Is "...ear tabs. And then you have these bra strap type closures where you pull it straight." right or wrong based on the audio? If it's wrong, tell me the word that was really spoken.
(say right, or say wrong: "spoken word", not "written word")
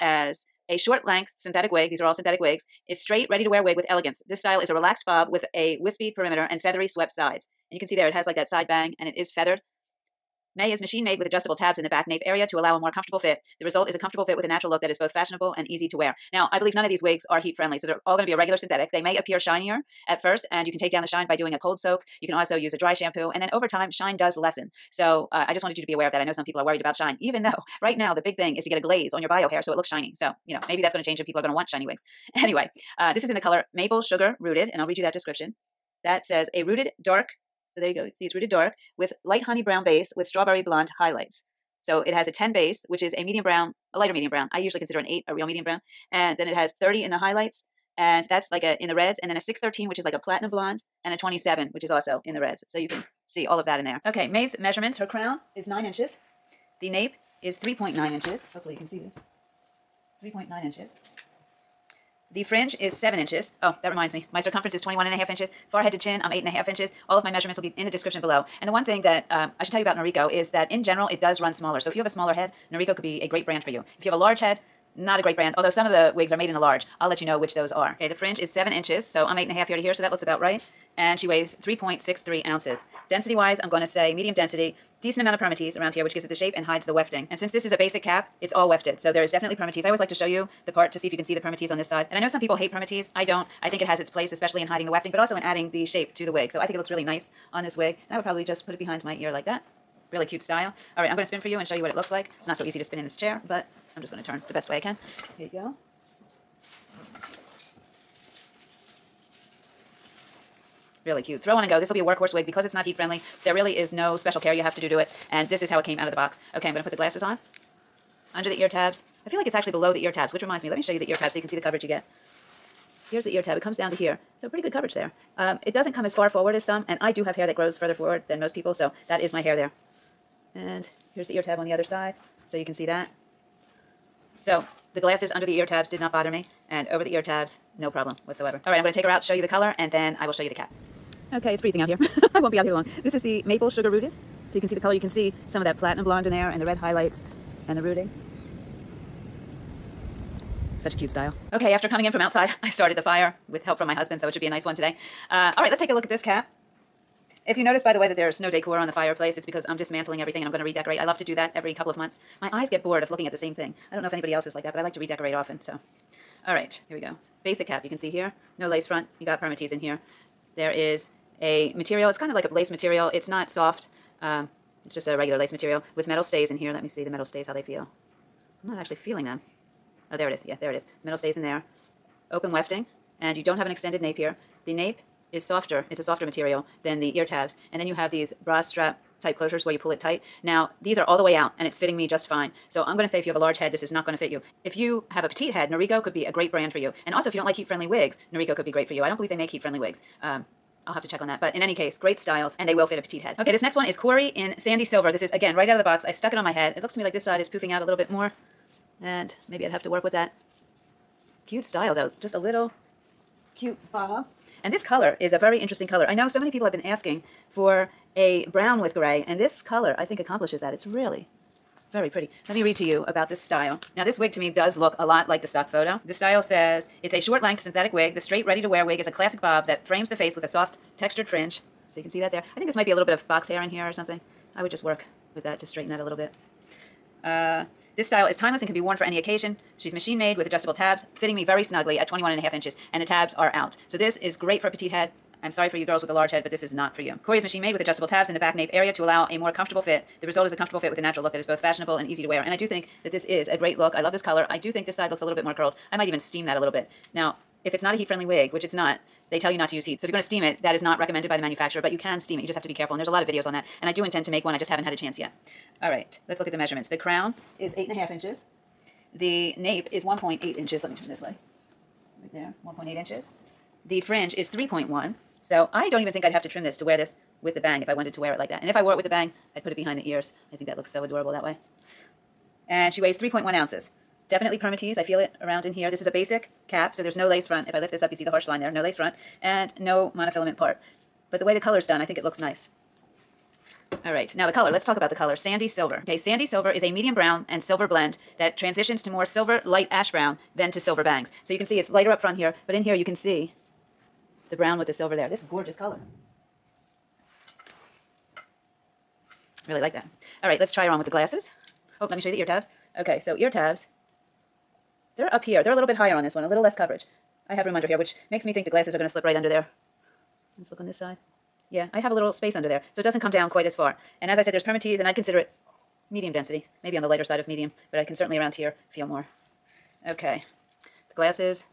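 wrong: "tight", not "straight".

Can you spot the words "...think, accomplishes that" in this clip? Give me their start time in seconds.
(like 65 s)
220 s.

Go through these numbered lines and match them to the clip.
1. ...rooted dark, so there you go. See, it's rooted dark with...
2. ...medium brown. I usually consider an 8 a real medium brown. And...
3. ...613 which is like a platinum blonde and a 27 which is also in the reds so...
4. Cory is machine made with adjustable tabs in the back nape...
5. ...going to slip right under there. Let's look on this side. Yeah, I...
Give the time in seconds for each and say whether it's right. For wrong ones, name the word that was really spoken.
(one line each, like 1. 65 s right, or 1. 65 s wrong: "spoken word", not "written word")
1. 36 s right
2. 44 s right
3. 49 s right
4. 247 s right
5. 318 s right.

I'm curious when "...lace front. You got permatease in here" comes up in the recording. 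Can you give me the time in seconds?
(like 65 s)
168 s.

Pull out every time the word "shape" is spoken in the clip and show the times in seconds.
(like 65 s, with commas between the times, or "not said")
86 s, 95 s.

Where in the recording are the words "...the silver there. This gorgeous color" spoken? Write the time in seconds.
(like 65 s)
304 s.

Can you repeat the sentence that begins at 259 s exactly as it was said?
So if you're gonna steam it, that is not recommended by the manufacturer, but you can steam it.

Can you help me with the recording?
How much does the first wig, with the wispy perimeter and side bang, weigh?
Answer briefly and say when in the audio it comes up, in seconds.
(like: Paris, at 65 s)
3.63 ounces, at 81 s.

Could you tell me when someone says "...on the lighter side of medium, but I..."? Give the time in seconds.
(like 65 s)
326 s.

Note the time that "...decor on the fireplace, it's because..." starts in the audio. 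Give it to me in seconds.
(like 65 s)
158 s.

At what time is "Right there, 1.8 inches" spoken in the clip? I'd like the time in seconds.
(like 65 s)
272 s.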